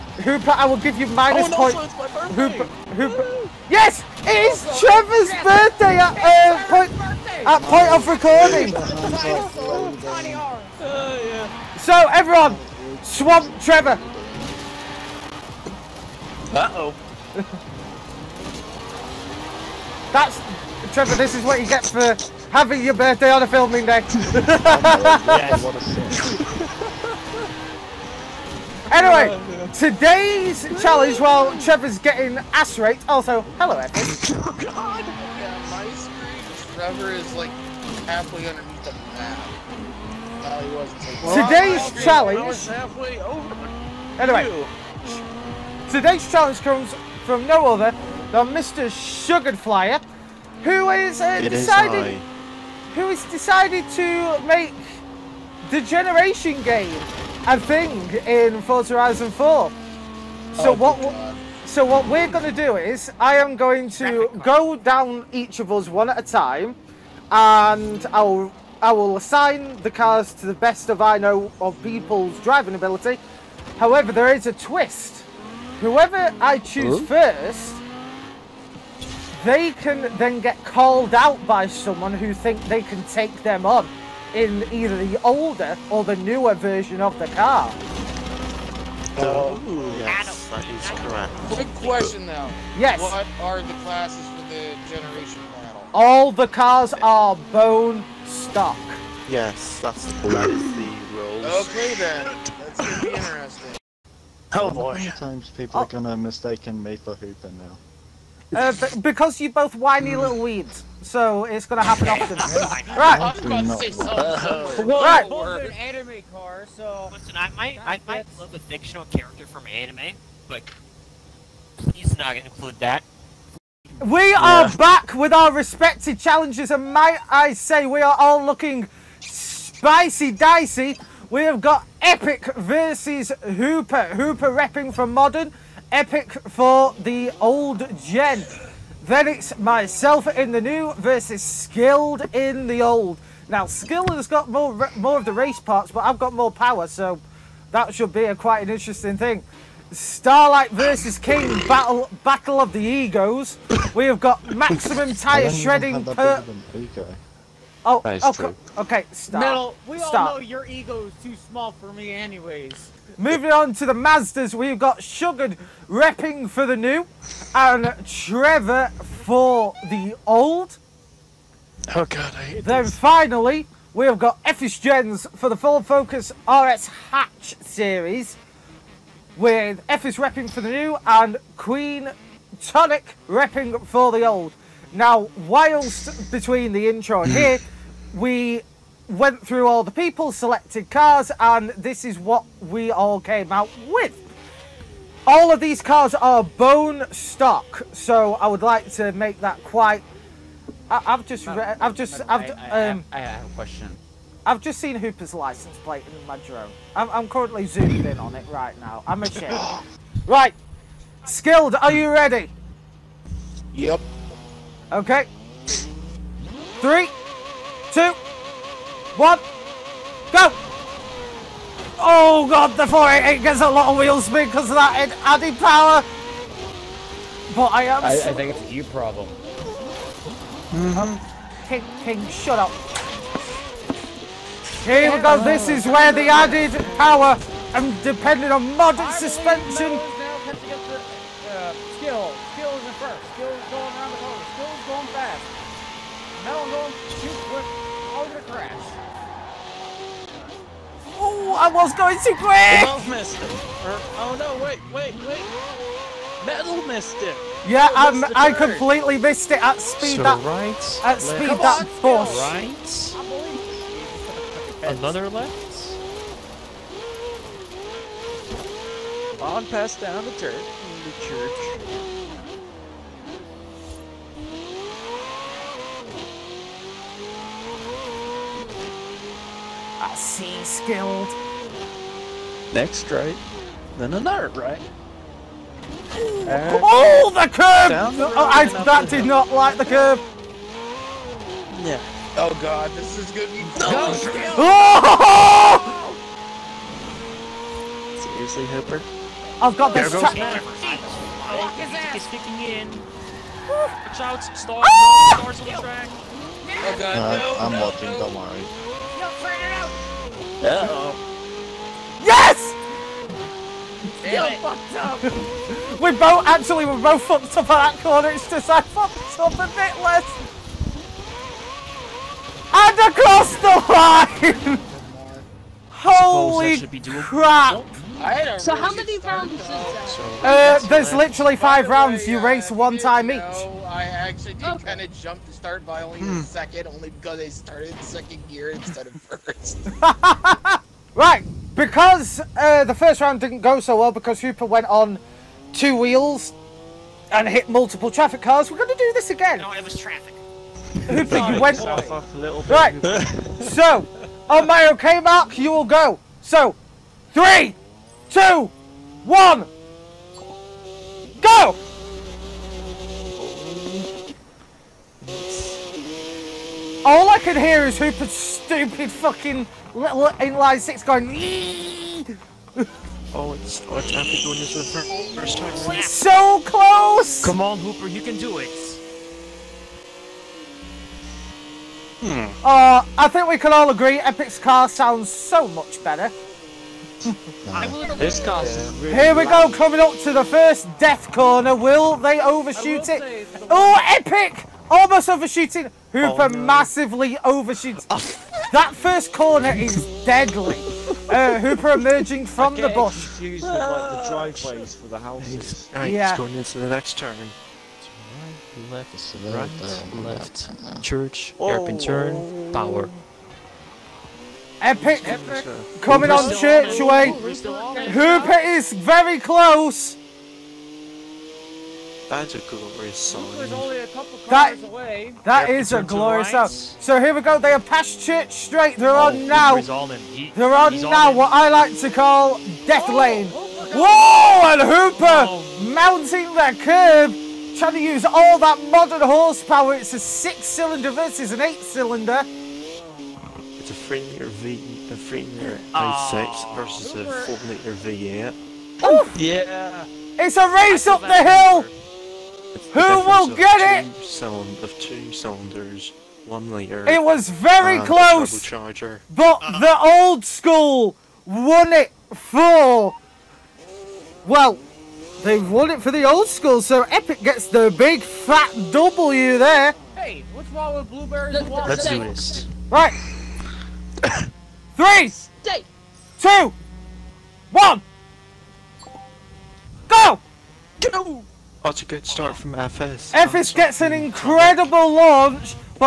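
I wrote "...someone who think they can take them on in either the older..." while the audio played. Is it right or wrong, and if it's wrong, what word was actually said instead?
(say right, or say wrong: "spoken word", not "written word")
right.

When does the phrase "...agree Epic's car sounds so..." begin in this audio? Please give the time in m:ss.
6:23.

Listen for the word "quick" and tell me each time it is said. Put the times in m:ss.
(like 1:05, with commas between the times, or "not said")
1:31, 4:07, 4:12.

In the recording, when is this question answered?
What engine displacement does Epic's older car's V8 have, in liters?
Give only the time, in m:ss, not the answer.
7:27.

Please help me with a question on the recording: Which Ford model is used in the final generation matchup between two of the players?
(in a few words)
Focus RS.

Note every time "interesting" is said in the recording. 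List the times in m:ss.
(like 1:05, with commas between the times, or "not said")
1:43, 2:28.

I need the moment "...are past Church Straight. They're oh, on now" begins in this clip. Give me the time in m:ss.
7:07.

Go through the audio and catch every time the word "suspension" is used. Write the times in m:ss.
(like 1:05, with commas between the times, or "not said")
3:59.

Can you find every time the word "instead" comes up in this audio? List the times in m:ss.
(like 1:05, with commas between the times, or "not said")
5:38.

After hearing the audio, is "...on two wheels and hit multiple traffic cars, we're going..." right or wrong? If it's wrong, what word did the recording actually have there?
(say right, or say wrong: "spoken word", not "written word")
right.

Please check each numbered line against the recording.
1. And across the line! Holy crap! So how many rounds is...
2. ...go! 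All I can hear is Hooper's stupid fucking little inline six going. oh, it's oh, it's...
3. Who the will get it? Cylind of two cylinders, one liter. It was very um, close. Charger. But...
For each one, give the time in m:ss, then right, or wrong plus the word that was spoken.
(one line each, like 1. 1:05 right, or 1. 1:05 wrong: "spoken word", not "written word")
1. 5:22 right
2. 6:01 right
3. 7:32 right.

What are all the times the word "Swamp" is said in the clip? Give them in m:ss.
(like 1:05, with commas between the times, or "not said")
0:13.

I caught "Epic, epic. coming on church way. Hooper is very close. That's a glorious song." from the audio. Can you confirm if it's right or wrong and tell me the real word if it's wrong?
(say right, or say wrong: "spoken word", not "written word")
right.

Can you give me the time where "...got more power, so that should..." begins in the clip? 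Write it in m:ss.
2:26.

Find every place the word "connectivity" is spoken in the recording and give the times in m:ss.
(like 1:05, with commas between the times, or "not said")
not said.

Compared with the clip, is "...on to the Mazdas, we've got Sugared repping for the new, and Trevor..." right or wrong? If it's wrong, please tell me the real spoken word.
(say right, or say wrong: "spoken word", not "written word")
right.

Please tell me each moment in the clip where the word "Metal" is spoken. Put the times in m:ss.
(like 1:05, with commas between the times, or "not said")
2:39, 4:06, 4:16.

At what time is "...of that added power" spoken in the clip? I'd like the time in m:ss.
3:44.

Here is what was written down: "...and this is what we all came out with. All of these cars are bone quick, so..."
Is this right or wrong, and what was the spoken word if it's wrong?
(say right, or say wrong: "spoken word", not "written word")
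wrong: "stock", not "quick".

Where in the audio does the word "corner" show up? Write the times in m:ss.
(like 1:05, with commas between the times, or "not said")
4:04, 5:18, 6:31, 6:39.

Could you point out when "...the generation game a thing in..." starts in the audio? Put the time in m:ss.
0:55.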